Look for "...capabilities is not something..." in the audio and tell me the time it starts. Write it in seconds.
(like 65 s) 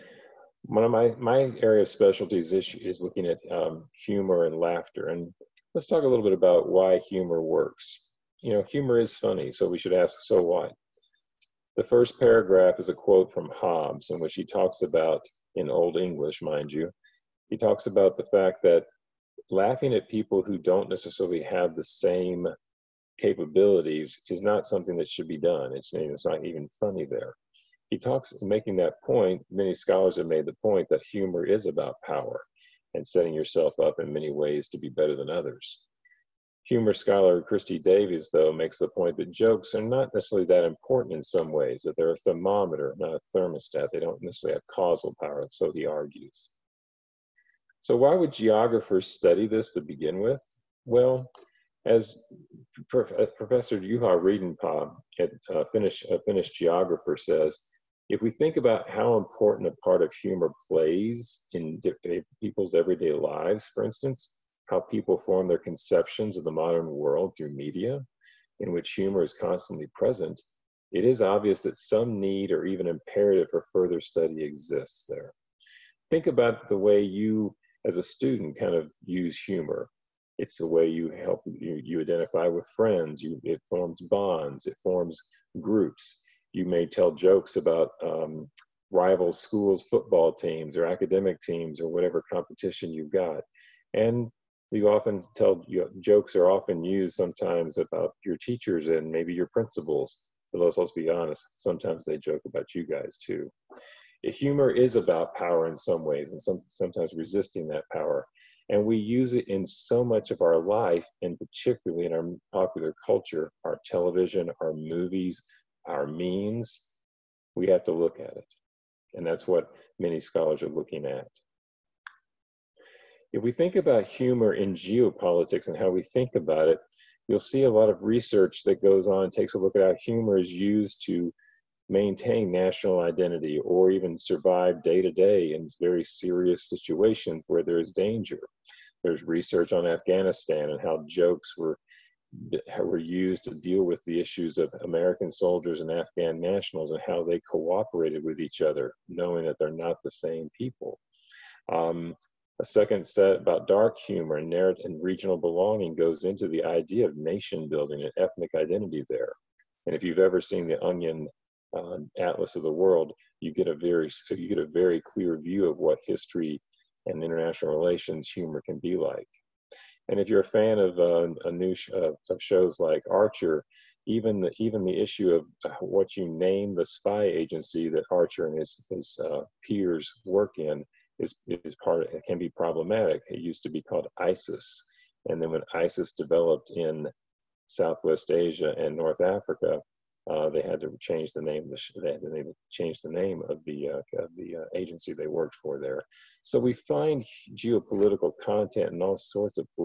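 23 s.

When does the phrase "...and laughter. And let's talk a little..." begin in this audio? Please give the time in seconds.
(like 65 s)
4 s.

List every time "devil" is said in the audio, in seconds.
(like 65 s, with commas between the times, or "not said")
not said.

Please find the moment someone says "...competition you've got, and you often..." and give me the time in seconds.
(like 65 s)
92 s.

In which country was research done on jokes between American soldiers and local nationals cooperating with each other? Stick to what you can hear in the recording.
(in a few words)
Afghanistan.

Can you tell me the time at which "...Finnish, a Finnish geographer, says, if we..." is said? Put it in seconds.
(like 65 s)
55 s.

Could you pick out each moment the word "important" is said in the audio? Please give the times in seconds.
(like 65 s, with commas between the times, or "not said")
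40 s, 59 s.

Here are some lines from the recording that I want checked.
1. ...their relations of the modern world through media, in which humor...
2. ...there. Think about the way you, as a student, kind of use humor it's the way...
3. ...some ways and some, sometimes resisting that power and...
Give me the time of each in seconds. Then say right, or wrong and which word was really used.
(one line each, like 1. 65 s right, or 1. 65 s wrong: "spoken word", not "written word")
1. 65 s wrong: "conceptions", not "relations"
2. 75 s right
3. 105 s right.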